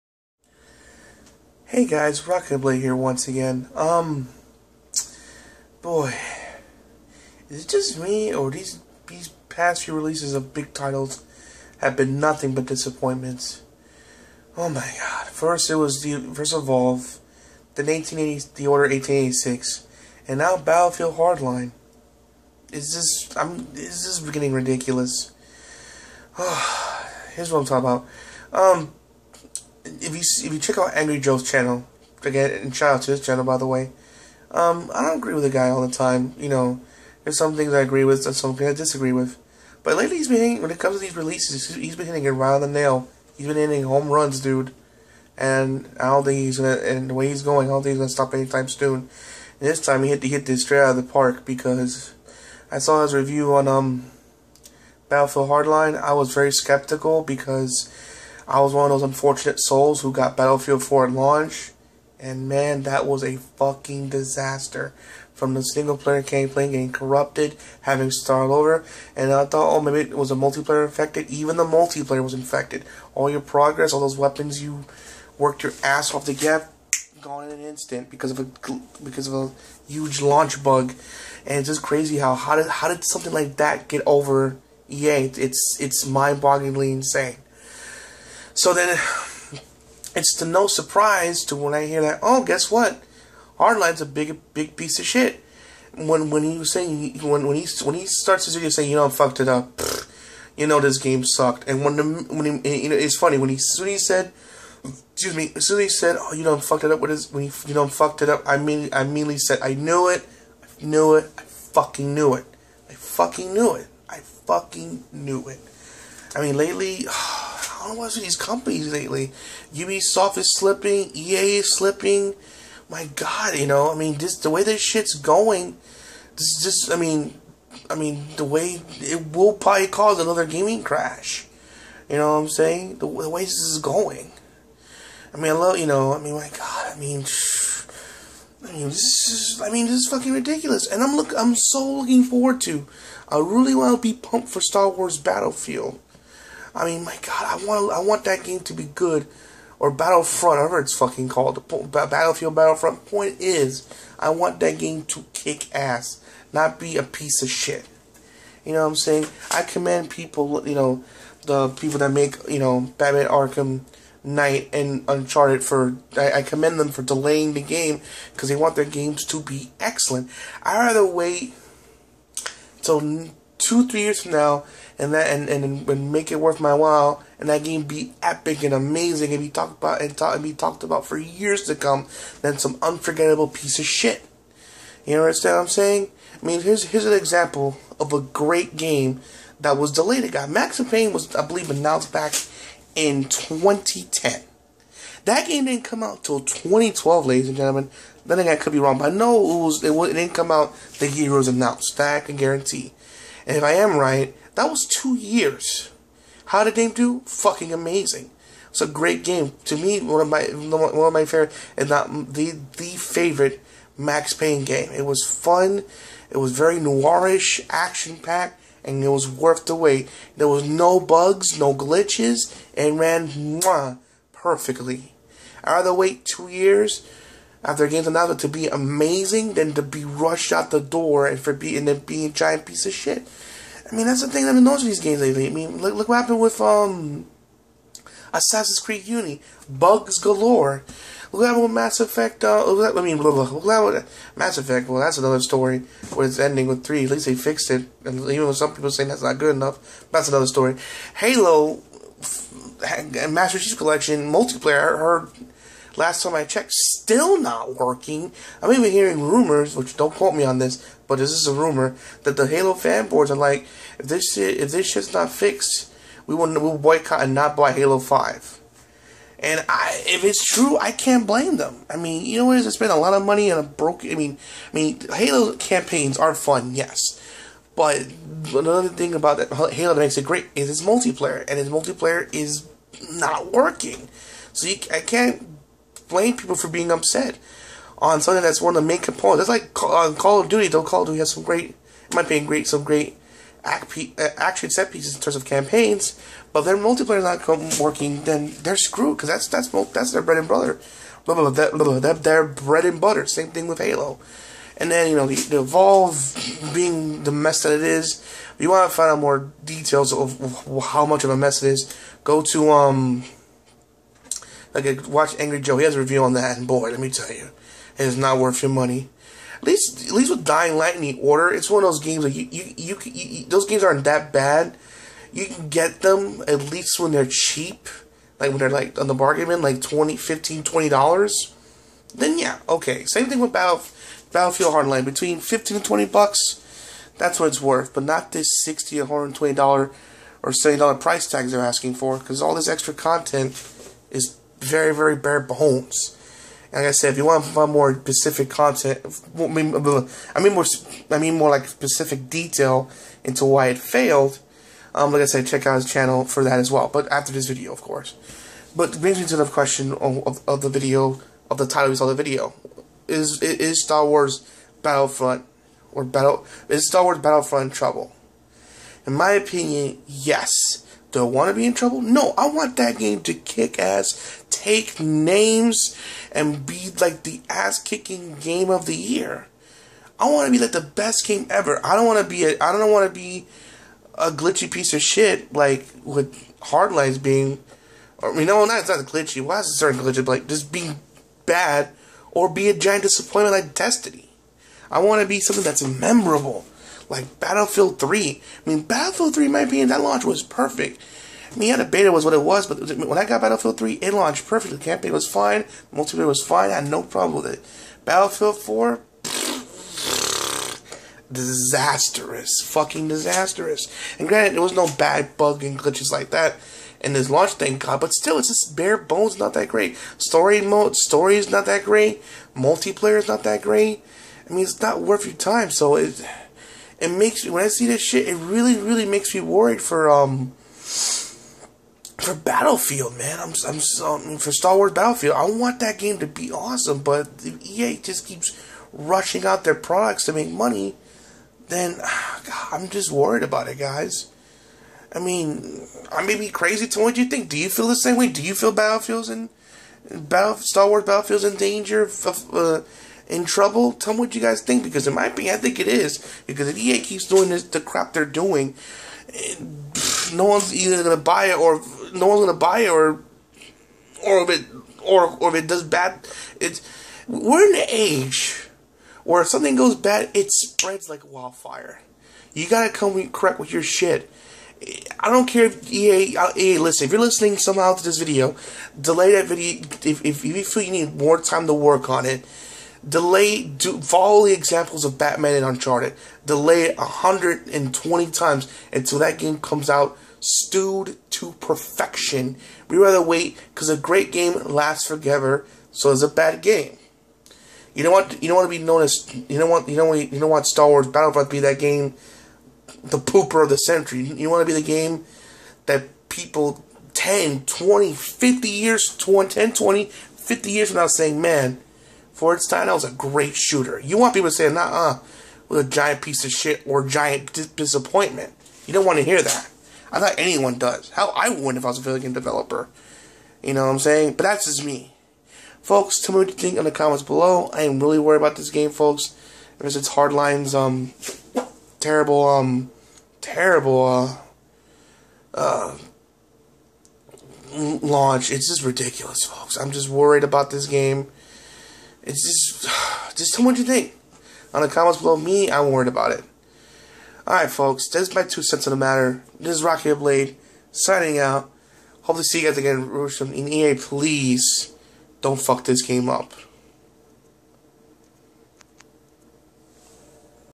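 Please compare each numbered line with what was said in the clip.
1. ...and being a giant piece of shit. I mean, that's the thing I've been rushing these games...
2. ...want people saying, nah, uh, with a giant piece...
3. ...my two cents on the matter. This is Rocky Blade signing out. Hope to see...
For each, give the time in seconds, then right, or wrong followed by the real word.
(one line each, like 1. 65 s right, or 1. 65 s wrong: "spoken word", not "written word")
1. 231 s wrong: "noticing", not "rushing"
2. 514 s right
3. 548 s right.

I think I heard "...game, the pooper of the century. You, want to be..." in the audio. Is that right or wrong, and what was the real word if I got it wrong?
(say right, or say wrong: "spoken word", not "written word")
right.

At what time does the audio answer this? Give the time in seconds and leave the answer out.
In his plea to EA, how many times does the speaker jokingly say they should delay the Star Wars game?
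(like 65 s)
486 s.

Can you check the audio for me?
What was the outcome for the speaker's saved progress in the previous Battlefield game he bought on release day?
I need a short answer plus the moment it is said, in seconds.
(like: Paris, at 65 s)
corrupted, at 66 s.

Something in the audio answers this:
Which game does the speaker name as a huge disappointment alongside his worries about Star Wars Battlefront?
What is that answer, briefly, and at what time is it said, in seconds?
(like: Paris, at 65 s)
Destiny, at 393 s.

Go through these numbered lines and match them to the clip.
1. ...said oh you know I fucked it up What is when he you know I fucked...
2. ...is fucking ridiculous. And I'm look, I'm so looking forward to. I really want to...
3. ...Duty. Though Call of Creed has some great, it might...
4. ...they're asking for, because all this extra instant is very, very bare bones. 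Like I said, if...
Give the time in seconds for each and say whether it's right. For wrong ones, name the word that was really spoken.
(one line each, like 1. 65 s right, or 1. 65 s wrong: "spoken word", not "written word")
1. 105 s right
2. 139 s right
3. 290 s wrong: "Duty", not "Creed"
4. 341 s wrong: "content", not "instant".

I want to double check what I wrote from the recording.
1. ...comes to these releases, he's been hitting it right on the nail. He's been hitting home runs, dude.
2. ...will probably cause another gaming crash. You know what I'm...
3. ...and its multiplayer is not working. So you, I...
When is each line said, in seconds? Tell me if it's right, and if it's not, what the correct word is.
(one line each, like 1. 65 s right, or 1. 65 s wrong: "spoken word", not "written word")
1. 40 s right
2. 129 s right
3. 281 s right.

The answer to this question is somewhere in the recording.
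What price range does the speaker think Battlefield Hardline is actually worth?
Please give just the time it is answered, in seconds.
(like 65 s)
335 s.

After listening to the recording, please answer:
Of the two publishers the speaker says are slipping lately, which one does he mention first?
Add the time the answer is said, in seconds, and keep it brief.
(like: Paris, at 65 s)
Ubisoft, at 119 s.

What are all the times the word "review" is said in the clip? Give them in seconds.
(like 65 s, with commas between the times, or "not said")
53 s, 315 s.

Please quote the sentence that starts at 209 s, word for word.
To me, one of my one of my favorite, and not the the favorite Max Payne game.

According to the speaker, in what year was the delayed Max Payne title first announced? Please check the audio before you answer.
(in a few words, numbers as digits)
2010.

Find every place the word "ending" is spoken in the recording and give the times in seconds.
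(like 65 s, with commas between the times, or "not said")
246 s.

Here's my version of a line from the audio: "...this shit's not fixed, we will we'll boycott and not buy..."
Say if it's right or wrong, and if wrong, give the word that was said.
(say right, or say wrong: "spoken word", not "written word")
right.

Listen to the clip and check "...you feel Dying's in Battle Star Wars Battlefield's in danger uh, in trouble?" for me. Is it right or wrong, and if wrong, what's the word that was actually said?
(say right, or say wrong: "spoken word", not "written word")
wrong: "Battlefield", not "Dying".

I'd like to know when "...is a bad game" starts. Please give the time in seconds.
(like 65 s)
496 s.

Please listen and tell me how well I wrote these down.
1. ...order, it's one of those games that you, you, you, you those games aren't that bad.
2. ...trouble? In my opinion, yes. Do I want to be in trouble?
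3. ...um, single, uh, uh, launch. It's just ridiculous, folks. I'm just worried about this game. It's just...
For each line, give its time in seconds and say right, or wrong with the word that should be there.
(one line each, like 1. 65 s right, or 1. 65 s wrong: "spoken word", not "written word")
1. 321 s right
2. 367 s right
3. 532 s wrong: "terrible", not "single".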